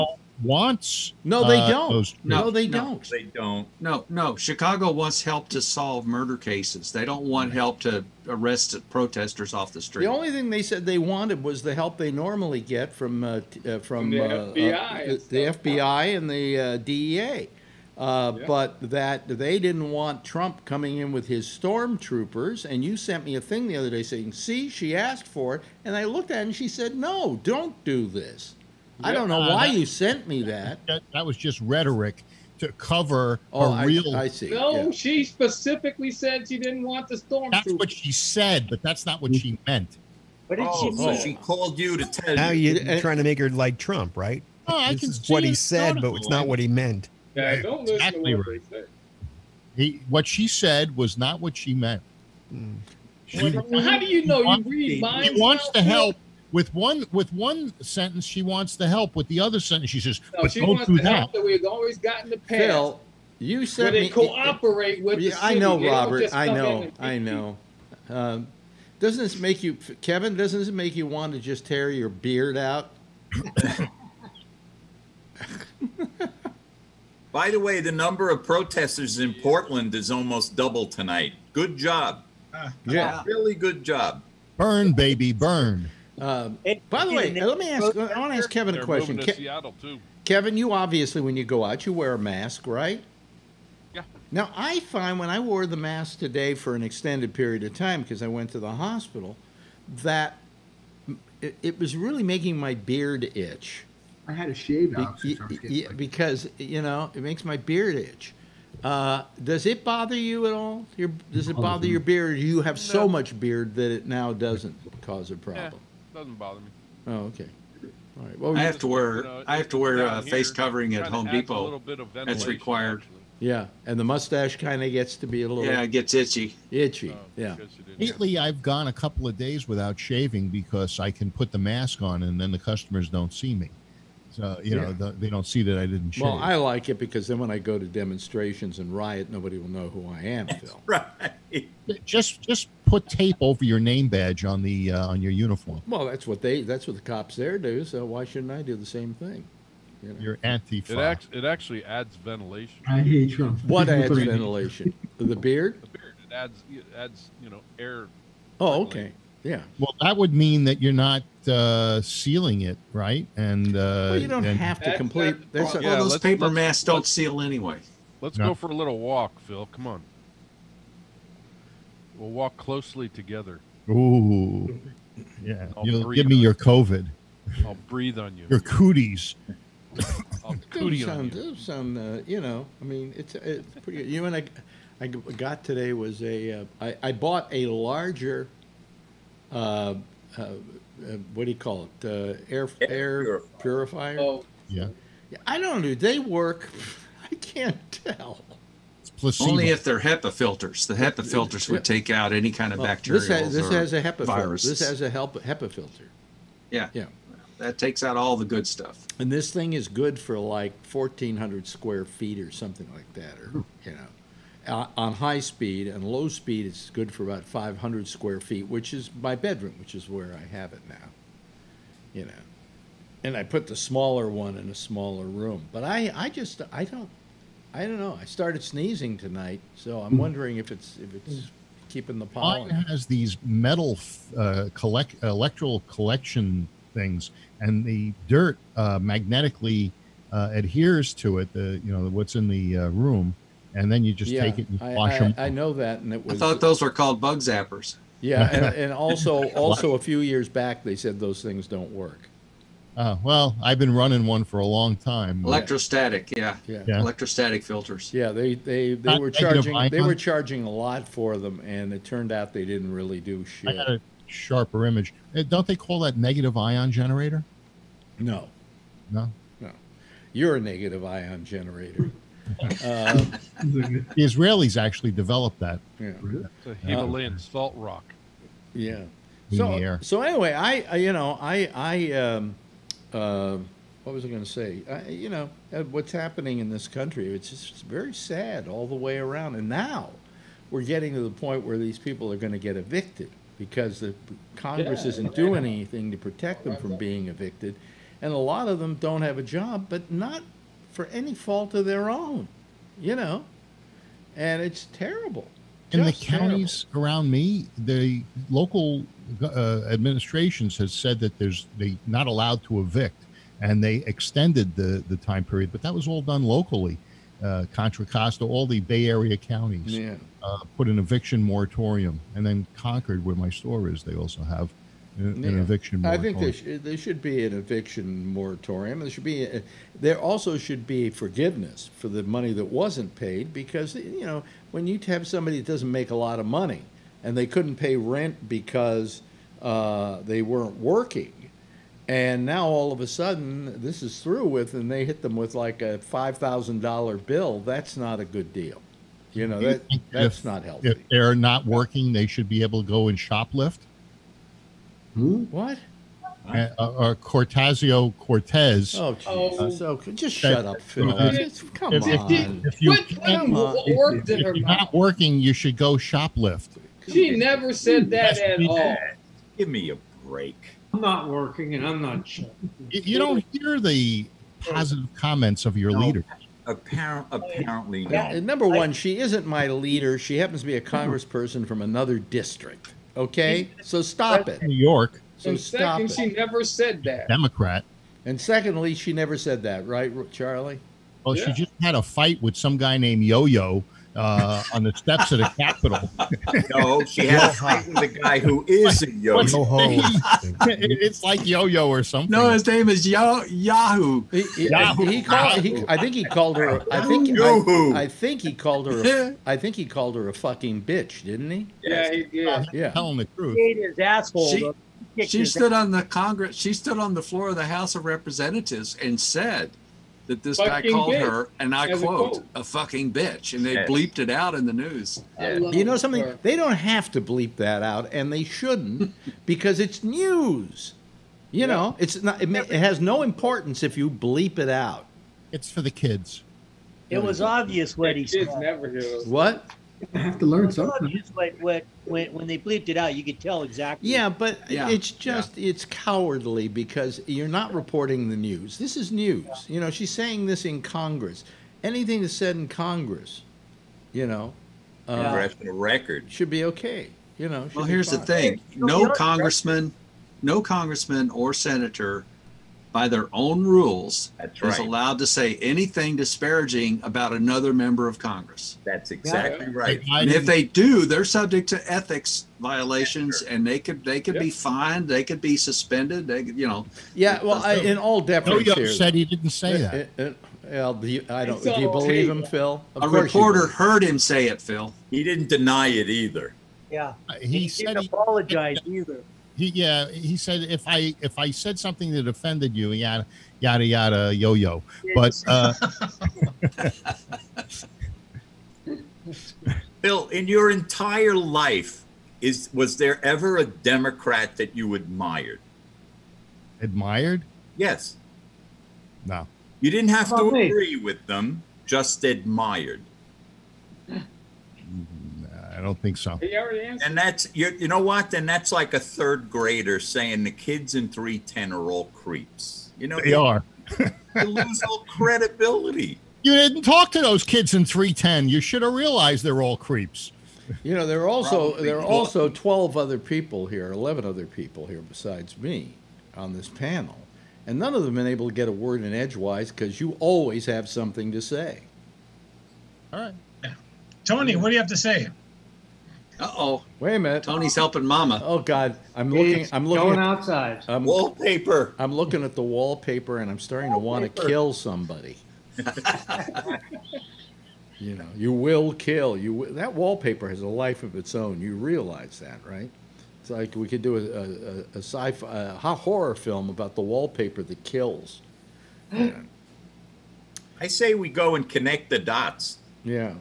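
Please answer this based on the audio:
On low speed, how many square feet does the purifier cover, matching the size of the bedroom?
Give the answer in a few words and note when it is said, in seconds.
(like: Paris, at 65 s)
500, at 217 s.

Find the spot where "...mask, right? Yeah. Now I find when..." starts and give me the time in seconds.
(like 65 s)
92 s.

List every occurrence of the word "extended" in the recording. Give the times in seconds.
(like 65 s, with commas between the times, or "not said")
96 s, 314 s.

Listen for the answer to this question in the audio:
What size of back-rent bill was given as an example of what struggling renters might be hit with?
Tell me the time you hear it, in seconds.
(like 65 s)
345 s.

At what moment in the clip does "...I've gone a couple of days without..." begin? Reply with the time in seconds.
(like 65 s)
128 s.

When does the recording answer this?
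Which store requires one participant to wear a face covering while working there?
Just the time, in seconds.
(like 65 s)
121 s.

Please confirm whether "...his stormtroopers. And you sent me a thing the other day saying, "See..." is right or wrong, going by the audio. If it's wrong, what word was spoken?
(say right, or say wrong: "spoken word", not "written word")
right.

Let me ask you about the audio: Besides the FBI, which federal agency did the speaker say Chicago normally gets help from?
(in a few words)
DEA.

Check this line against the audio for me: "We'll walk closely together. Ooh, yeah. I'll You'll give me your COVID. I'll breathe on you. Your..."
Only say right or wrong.
right.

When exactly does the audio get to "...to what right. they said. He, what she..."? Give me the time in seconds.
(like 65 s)
48 s.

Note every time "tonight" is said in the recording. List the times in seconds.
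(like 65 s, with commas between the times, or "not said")
80 s, 229 s.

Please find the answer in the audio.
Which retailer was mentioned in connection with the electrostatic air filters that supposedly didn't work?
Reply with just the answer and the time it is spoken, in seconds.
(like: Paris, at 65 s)
Sharper Image, at 263 s.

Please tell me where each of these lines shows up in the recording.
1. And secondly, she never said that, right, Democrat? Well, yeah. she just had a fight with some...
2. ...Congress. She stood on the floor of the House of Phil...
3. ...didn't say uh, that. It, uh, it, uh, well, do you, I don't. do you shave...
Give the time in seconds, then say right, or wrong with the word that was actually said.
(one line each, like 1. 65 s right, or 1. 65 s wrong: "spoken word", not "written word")
1. 388 s wrong: "Charlie", not "Democrat"
2. 416 s wrong: "Representatives", not "Phil"
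3. 479 s wrong: "believe", not "shave".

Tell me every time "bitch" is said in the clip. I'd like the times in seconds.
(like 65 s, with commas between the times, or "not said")
410 s, 423 s.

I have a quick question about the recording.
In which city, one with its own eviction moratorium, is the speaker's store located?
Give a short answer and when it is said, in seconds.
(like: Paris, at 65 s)
Concord, at 322 s.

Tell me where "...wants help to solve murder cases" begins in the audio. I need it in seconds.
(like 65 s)
4 s.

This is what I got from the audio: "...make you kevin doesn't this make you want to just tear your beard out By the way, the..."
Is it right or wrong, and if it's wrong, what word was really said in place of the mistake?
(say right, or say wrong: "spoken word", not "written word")
right.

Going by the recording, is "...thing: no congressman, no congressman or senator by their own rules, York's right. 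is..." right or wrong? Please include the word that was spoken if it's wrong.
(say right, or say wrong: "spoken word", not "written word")
wrong: "That", not "York".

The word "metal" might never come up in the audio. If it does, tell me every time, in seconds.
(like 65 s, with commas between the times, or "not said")
233 s.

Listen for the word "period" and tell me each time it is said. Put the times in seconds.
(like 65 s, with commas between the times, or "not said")
97 s, 315 s.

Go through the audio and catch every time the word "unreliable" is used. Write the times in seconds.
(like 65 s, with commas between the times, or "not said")
not said.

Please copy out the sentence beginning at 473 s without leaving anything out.
and they could they could yep.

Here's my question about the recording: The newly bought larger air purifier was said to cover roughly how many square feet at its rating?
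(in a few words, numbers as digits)
1,400.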